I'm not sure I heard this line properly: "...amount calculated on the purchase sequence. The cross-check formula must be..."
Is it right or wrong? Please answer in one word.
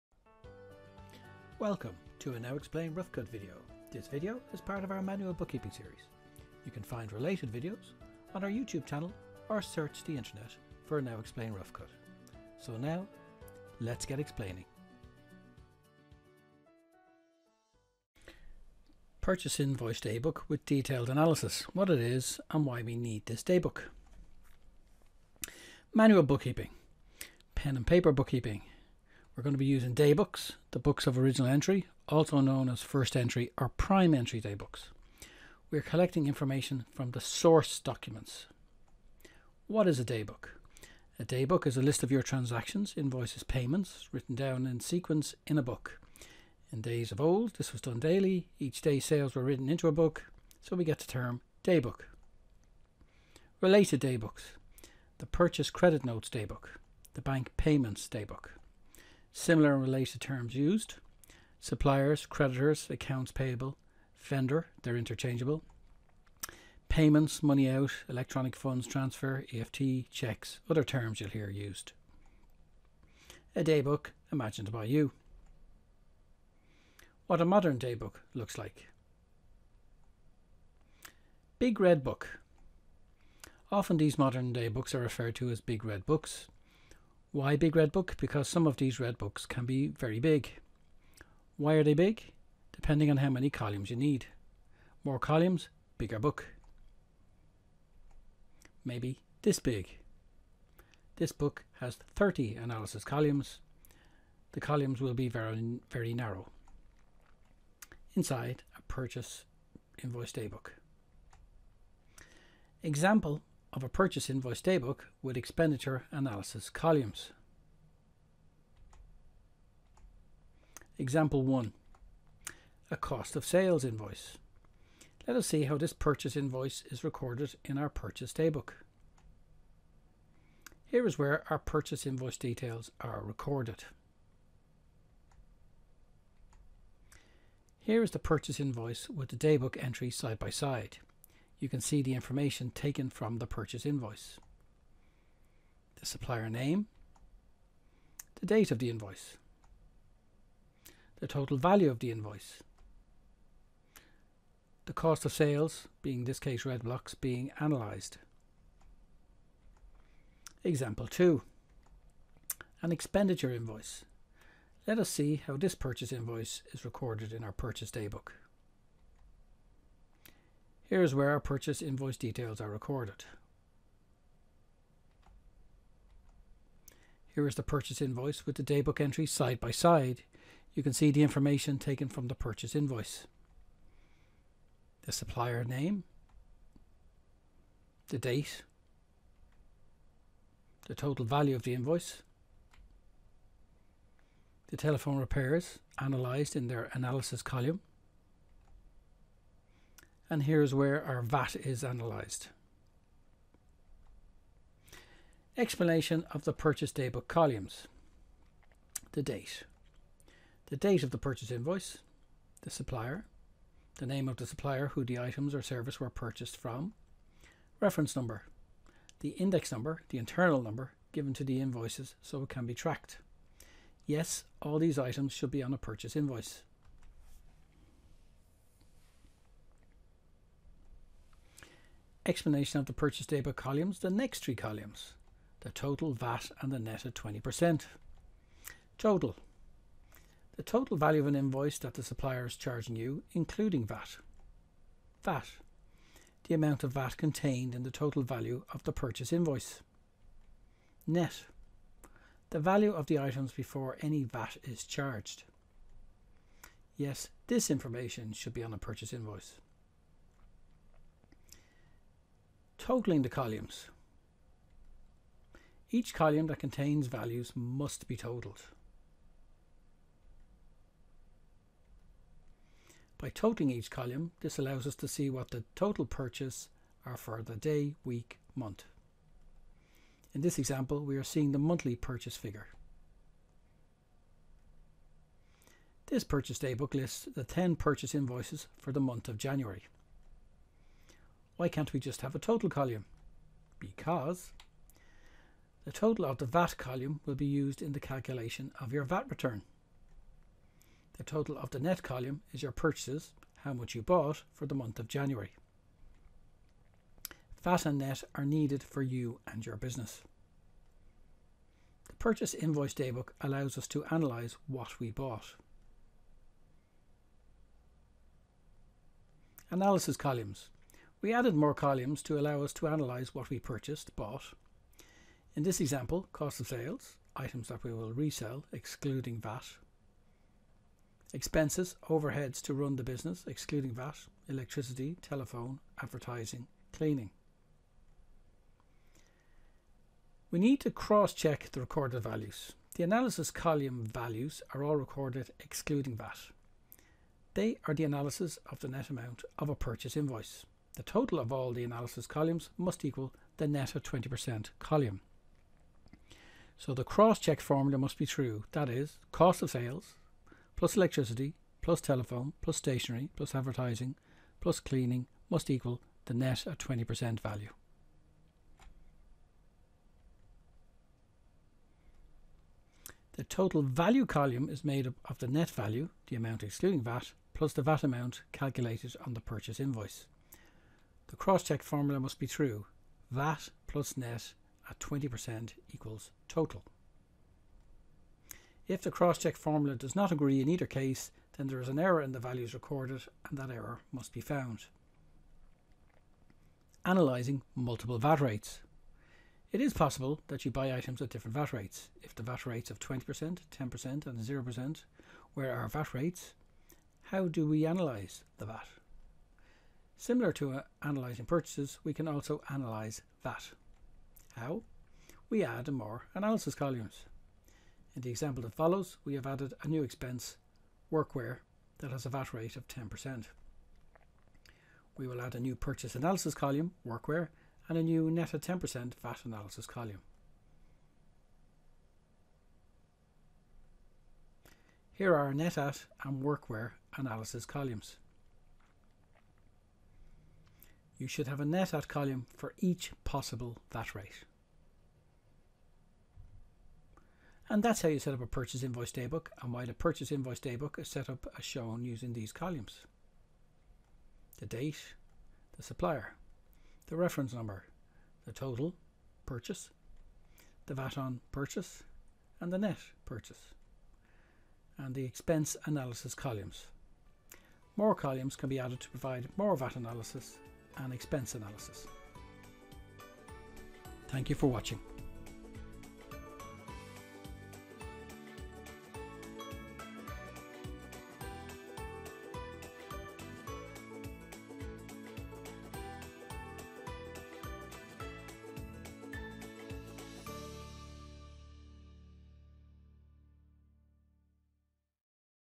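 wrong.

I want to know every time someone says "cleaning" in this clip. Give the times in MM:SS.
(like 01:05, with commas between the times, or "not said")
05:36, 06:04.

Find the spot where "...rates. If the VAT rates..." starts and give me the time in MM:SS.
06:41.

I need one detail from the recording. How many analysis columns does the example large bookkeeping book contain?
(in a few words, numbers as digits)
30.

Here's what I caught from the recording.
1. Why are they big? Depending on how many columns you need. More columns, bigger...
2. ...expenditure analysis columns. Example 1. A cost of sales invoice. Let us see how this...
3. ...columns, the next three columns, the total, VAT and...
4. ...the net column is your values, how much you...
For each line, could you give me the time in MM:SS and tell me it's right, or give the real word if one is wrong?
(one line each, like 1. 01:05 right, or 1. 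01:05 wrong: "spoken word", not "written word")
1. 01:31 right
2. 01:55 right
3. 03:53 right
4. 05:01 wrong: "purchases", not "values".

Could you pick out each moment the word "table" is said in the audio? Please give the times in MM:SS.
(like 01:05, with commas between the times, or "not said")
not said.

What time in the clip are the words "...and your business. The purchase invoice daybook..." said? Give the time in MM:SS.
05:09.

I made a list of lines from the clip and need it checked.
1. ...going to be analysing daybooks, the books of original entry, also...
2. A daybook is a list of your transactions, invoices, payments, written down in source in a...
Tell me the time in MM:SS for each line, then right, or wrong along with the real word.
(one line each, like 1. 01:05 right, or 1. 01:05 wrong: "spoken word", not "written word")
1. 00:29 wrong: "using", not "analysing"
2. 00:41 wrong: "sequence", not "source".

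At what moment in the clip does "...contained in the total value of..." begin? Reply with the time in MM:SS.
04:07.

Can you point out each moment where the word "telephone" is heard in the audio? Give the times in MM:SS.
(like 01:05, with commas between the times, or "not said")
03:14, 05:35, 06:02.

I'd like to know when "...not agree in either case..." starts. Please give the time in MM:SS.
06:30.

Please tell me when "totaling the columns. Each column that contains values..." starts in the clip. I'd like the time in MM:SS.
04:22.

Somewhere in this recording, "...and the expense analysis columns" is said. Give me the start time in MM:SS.
07:44.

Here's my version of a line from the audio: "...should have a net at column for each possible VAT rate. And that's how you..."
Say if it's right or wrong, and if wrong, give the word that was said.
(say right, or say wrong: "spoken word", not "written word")
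right.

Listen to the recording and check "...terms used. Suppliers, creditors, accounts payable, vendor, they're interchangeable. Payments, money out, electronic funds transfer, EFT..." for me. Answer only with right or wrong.
right.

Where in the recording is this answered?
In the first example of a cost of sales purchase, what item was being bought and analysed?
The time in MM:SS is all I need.
02:36.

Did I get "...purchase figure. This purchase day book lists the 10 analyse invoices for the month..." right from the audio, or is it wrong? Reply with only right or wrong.
wrong.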